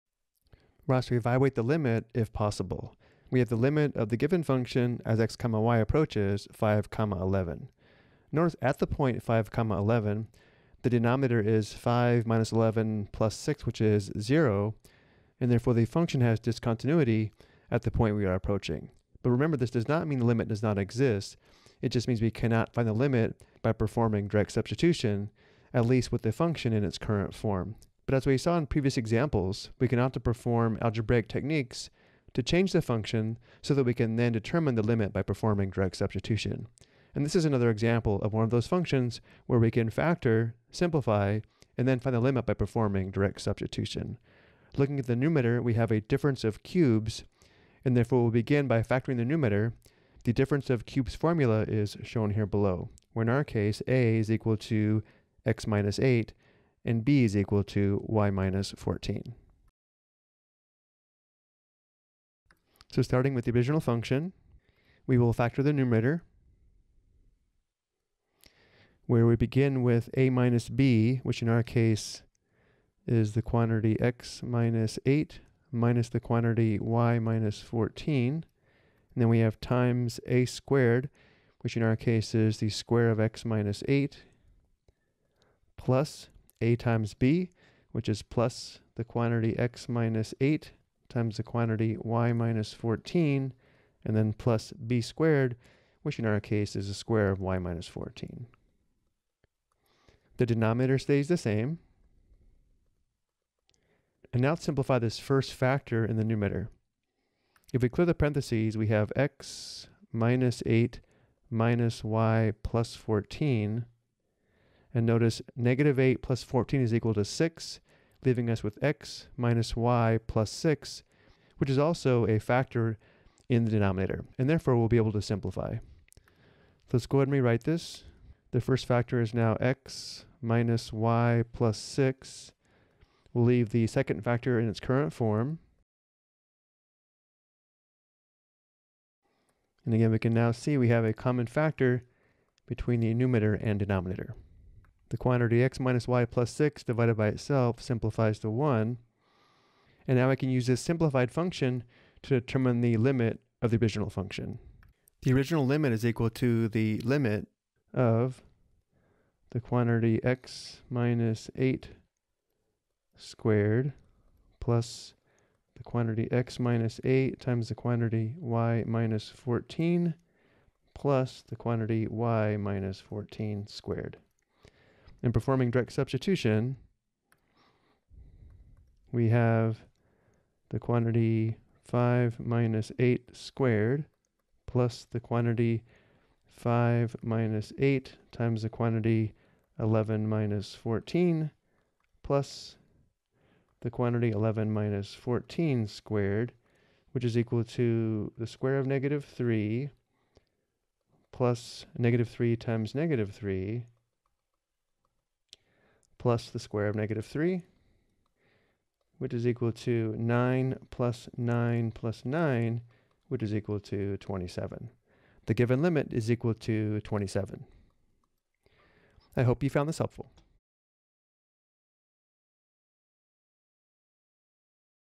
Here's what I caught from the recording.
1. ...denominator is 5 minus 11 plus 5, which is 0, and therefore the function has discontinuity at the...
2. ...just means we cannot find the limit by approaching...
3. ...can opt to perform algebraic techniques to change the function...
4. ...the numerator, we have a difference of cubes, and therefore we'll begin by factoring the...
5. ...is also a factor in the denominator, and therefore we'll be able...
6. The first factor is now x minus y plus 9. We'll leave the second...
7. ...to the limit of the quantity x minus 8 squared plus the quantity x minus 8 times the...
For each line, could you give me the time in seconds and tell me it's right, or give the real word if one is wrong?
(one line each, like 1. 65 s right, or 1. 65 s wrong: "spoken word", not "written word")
1. 10 s wrong: "6", not "5"
2. 21 s wrong: "performing", not "approaching"
3. 29 s right
4. 45 s right
5. 121 s right
6. 128 s wrong: "6", not "9"
7. 156 s right.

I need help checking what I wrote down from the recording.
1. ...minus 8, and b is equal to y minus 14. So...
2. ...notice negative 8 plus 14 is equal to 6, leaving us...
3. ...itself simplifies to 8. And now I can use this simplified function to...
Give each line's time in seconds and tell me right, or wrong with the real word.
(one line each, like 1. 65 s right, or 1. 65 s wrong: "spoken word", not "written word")
1. 55 s right
2. 115 s right
3. 147 s wrong: "1", not "8".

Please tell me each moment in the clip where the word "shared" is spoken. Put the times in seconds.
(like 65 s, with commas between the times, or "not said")
not said.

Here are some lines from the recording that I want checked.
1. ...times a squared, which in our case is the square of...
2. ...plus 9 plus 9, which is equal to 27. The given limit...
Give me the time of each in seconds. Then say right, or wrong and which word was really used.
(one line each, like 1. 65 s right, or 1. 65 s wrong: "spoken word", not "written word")
1. 79 s right
2. 210 s right.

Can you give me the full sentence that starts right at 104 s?
And now simplify this first factor in the numerator.